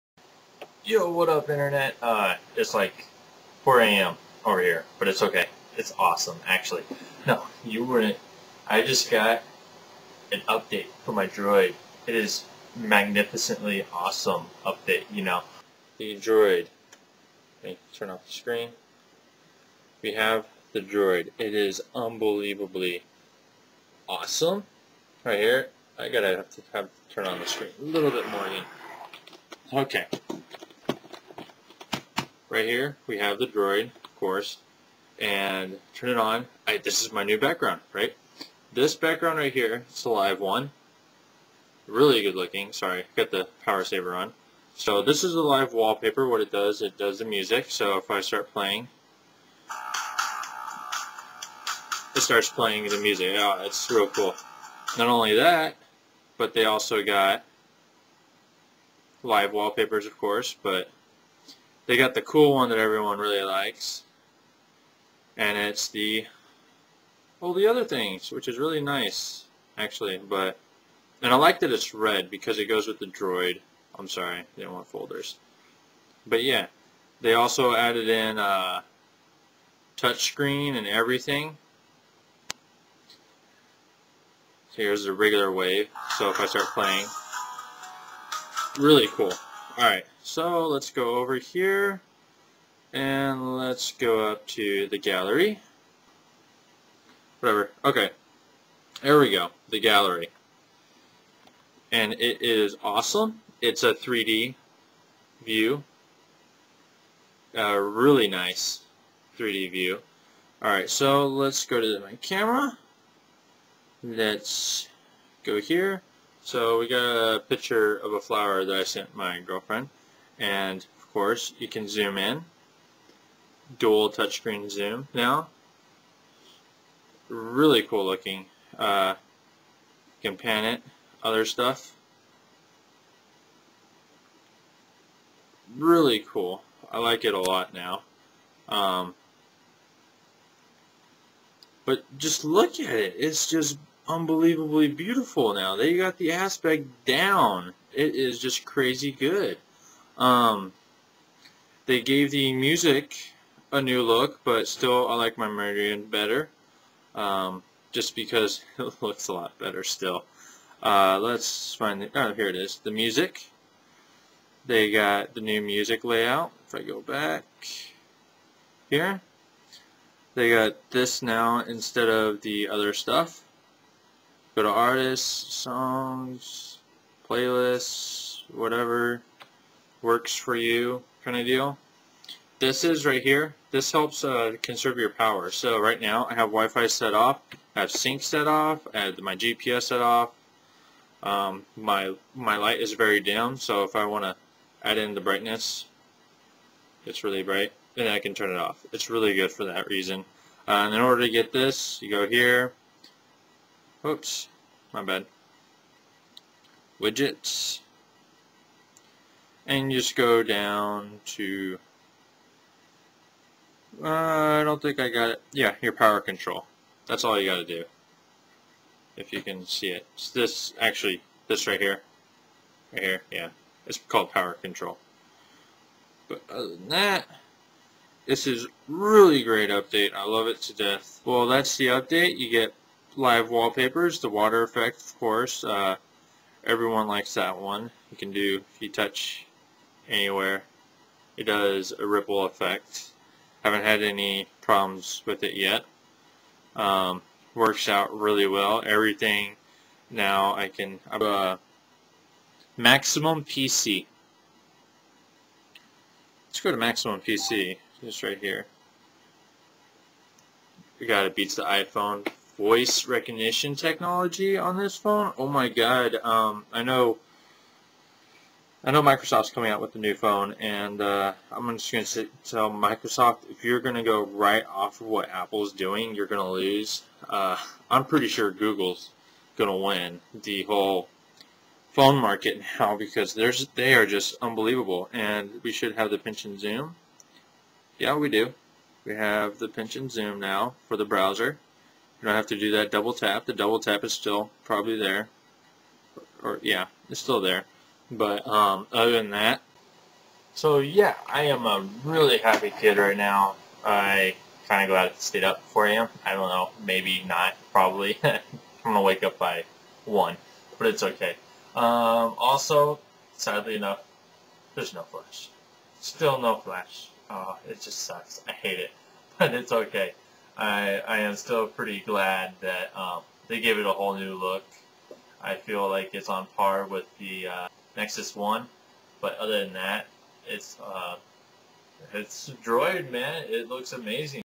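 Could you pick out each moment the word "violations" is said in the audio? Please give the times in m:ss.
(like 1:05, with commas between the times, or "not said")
not said.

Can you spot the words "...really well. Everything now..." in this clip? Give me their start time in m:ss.
4:08.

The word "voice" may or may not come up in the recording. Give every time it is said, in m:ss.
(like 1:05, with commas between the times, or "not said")
4:22.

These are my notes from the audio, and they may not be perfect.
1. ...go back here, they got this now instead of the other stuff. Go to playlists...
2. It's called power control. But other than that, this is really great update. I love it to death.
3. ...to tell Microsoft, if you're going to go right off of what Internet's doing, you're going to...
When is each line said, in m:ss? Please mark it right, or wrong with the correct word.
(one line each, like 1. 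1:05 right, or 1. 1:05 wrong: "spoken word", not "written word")
1. 2:46 wrong: "artists", not "playlists"
2. 3:43 right
3. 4:32 wrong: "Apple", not "Internet".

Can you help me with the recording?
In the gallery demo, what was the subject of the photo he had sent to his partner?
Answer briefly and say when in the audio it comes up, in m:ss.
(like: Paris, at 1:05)
a flower, at 1:58.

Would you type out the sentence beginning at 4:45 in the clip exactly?
And we should have the pinch and zoom.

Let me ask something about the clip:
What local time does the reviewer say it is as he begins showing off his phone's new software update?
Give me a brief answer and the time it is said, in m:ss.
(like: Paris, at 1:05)
4 a.m., at 0:03.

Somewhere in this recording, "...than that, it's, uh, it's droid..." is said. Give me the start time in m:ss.
5:29.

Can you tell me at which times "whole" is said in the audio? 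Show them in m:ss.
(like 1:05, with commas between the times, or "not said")
4:40, 5:23.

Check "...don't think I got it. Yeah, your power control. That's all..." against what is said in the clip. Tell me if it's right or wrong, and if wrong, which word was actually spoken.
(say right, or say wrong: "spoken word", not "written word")
right.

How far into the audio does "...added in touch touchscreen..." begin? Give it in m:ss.
1:17.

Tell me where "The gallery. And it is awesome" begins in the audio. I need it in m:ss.
1:39.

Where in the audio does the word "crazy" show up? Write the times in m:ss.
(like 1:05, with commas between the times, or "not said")
2:28.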